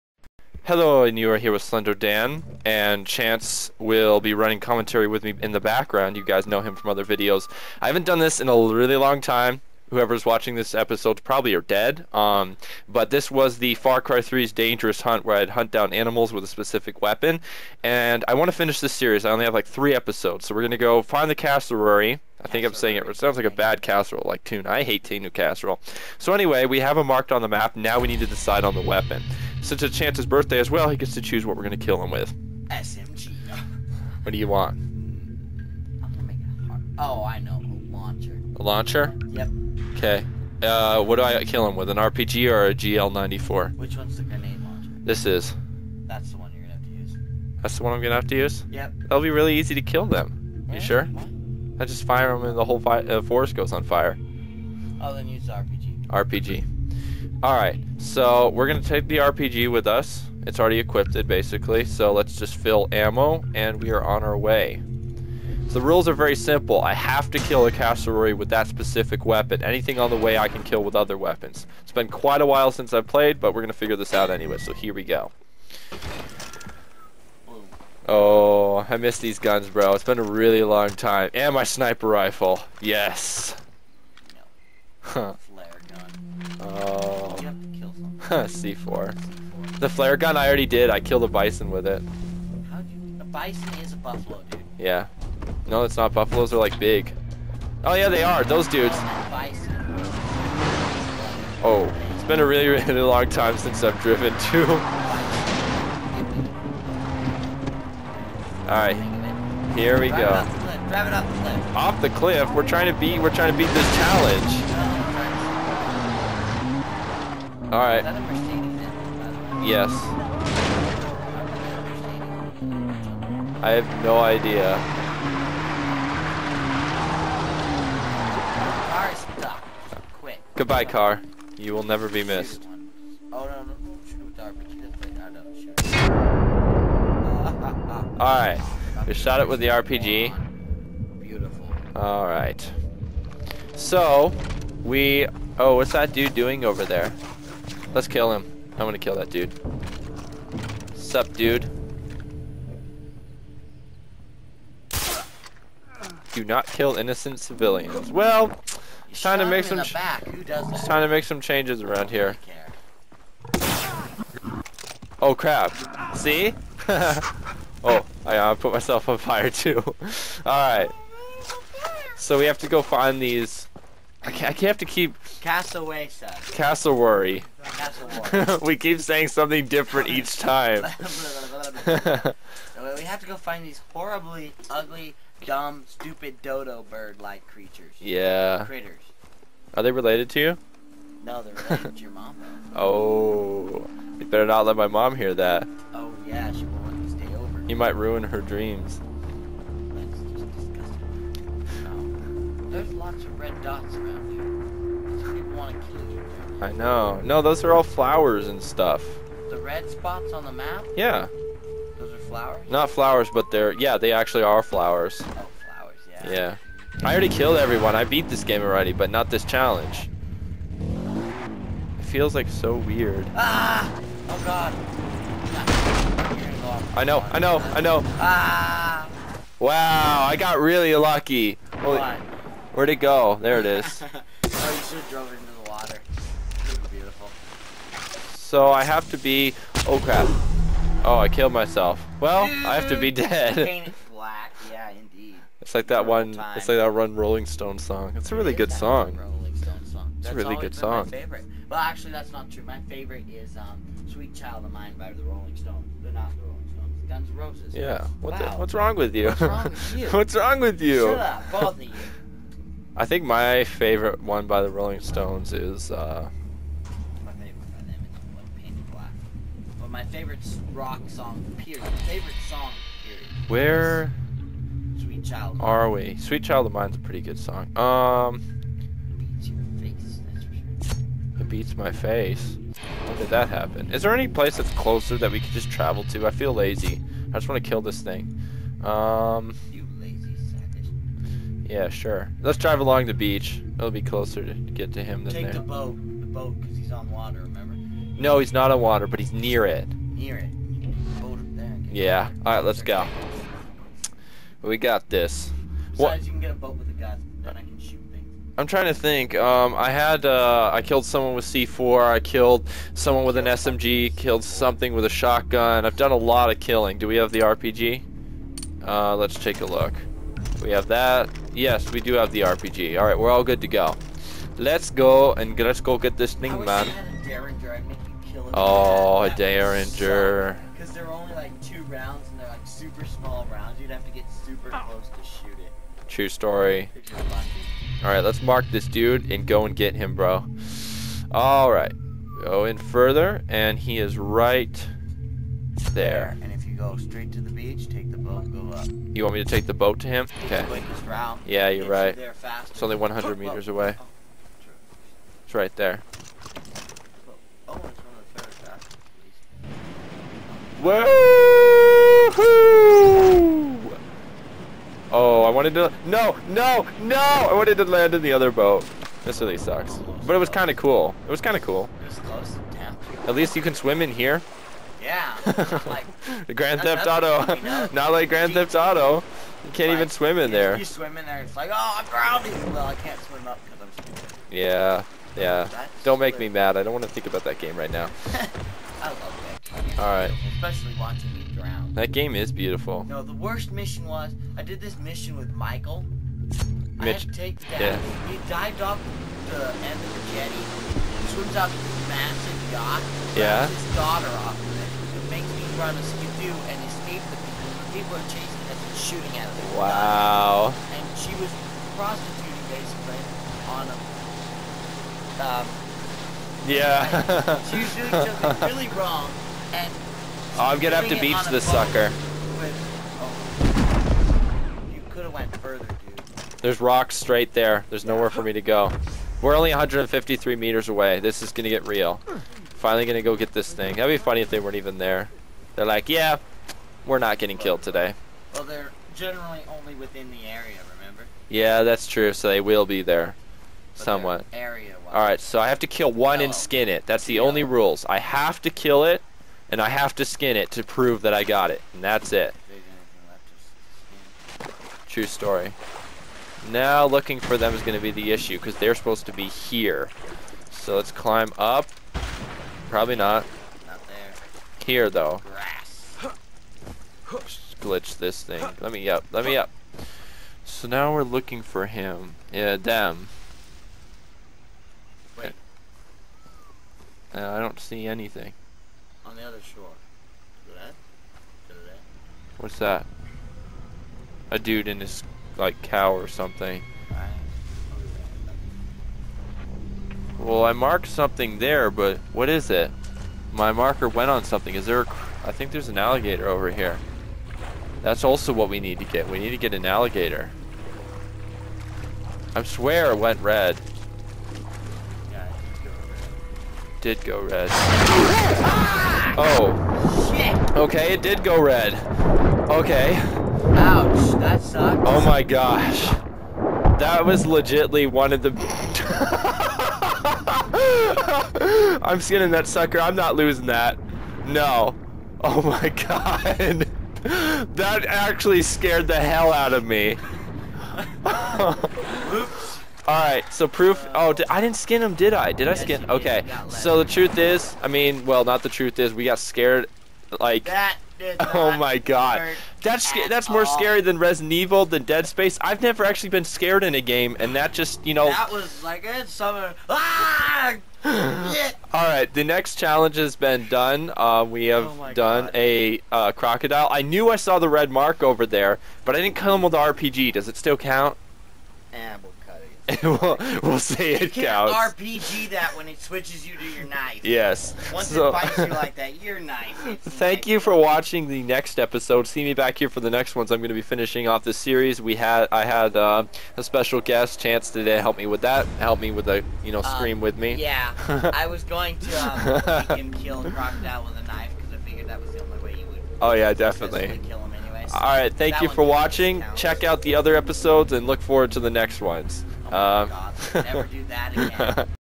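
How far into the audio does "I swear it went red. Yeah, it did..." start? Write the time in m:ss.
8:22.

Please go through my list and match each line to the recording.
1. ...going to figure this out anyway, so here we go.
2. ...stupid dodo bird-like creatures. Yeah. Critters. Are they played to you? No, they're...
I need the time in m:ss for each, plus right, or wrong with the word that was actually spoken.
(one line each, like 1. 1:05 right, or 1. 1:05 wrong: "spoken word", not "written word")
1. 1:13 right
2. 3:05 wrong: "related", not "played".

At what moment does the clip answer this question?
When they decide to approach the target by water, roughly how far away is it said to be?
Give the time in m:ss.
5:52.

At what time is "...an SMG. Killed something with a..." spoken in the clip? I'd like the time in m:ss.
5:13.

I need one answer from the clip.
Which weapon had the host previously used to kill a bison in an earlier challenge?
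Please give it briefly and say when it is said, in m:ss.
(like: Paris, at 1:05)
The flare gun, at 1:29.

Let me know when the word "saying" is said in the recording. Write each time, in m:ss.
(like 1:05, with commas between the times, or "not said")
0:22, 2:58.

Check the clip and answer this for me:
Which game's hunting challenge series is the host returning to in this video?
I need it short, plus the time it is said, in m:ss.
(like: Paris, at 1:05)
Far Cry 3, at 0:13.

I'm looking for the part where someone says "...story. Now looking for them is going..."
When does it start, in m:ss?
7:35.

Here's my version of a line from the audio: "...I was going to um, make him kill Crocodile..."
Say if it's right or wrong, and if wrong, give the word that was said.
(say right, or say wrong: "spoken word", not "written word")
right.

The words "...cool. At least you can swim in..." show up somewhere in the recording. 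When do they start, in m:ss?
6:11.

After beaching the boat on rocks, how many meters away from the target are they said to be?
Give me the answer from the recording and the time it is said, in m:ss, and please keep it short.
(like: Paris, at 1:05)
153, at 7:09.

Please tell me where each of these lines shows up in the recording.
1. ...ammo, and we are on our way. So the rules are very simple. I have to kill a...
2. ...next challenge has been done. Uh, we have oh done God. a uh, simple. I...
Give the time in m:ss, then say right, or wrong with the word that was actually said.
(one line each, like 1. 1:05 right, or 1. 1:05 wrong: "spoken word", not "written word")
1. 1:02 right
2. 9:12 wrong: "crocodile", not "simple".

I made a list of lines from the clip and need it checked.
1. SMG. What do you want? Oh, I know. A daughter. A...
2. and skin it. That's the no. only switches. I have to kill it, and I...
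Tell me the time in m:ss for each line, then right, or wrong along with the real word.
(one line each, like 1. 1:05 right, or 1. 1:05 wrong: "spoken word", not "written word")
1. 0:32 wrong: "launcher", not "daughter"
2. 7:26 wrong: "rules", not "switches".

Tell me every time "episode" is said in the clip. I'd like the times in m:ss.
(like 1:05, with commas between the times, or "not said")
0:10, 0:19, 9:31, 9:50.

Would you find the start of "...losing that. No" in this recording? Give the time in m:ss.
8:43.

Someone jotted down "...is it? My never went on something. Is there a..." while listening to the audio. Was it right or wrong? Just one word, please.
wrong.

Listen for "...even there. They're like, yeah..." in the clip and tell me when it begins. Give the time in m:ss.
7:14.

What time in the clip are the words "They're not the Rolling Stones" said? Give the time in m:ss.
4:16.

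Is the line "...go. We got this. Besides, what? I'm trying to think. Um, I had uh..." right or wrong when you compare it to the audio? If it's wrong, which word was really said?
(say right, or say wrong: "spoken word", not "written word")
right.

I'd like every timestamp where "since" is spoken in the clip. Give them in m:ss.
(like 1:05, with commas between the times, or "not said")
0:29, 1:12, 1:43.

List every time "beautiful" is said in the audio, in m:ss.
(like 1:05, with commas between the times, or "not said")
2:21, 6:32.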